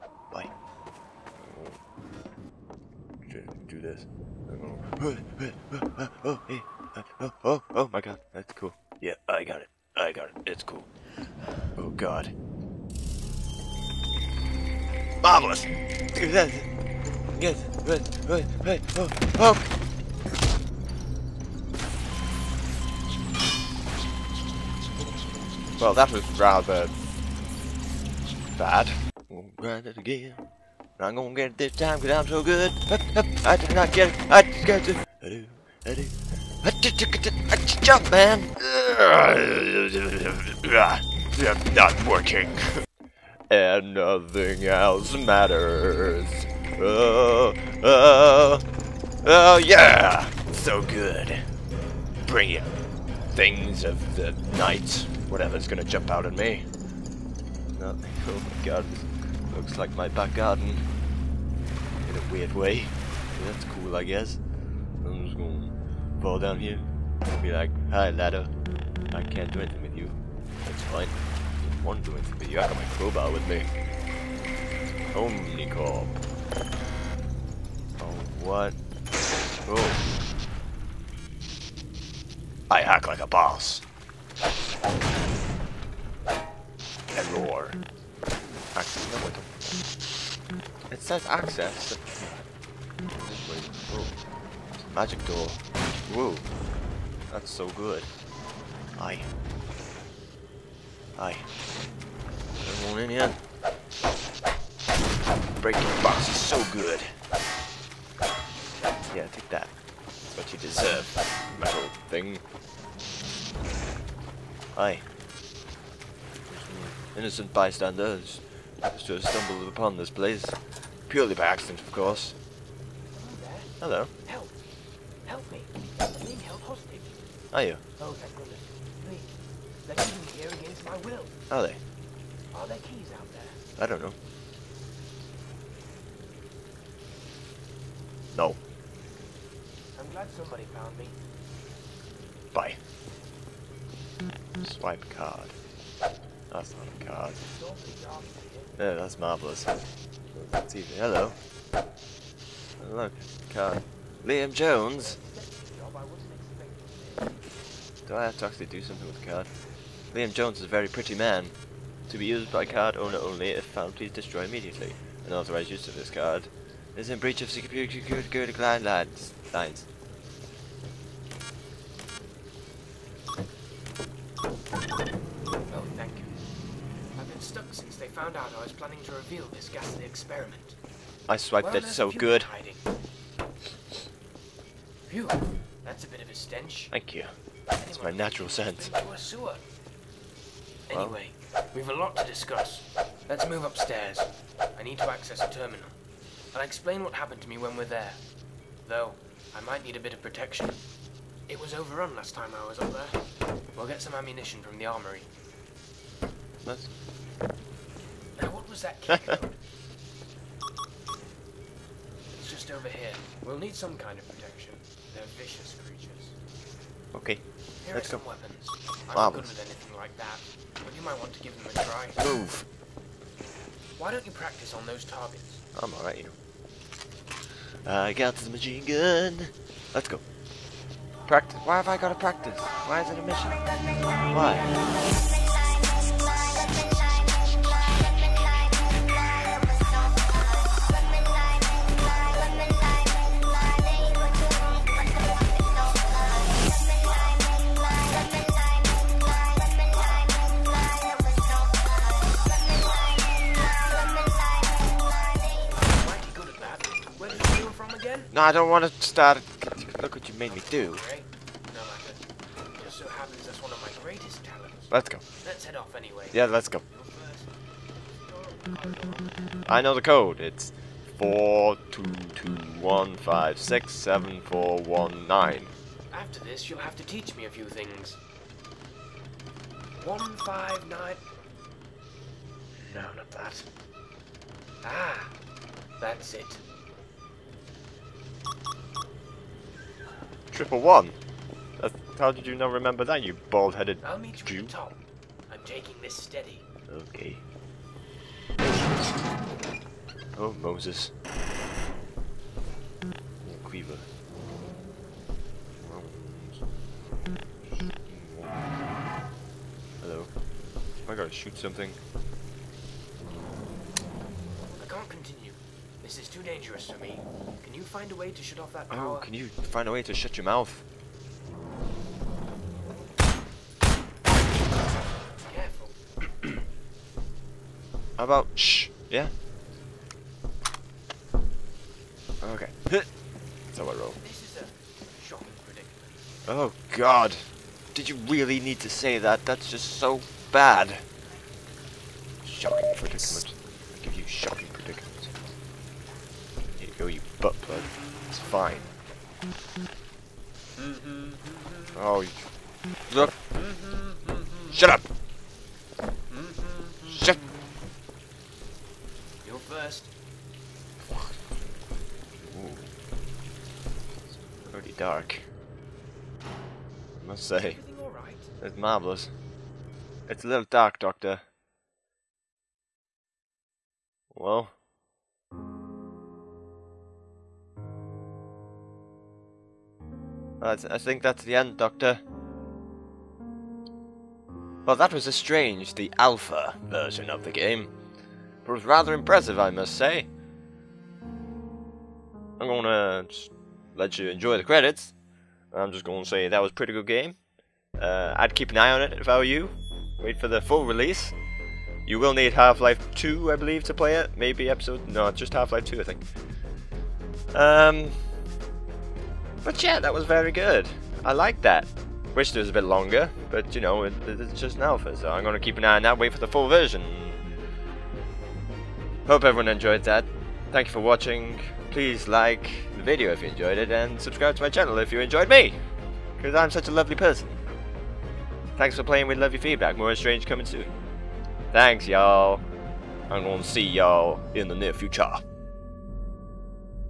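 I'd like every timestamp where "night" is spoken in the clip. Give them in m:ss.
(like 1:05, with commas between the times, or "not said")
0:54.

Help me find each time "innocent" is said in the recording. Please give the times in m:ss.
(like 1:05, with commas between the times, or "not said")
1:57.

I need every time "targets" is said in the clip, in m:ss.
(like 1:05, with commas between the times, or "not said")
3:45.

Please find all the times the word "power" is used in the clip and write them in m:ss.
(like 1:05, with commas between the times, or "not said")
5:18.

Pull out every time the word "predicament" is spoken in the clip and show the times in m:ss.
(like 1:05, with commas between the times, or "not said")
5:35, 5:42.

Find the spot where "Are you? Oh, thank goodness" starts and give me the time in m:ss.
2:07.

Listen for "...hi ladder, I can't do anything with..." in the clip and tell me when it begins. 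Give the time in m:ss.
1:07.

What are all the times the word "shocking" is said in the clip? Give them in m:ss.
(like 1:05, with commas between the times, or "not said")
5:35, 5:42.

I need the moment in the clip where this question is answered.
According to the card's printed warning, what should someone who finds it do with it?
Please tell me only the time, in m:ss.
2:44.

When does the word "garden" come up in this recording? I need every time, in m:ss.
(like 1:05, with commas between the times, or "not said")
1:00.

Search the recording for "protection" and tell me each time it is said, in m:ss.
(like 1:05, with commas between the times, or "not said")
3:20, 3:34.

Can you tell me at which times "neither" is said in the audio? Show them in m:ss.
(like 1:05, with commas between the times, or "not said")
not said.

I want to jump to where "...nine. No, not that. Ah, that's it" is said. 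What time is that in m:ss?
4:40.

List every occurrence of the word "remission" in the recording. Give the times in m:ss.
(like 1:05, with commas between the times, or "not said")
not said.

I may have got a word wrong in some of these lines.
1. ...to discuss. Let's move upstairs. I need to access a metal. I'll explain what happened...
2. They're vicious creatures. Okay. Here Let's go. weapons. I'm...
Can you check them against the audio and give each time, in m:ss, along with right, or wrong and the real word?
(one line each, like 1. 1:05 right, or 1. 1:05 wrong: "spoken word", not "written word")
1. 3:12 wrong: "terminal", not "metal"
2. 3:35 right.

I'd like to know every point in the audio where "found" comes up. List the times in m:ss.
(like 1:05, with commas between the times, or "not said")
2:20, 2:43.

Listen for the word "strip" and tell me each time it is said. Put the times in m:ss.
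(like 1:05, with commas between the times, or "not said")
not said.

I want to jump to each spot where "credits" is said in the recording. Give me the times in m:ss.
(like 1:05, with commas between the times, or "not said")
6:34.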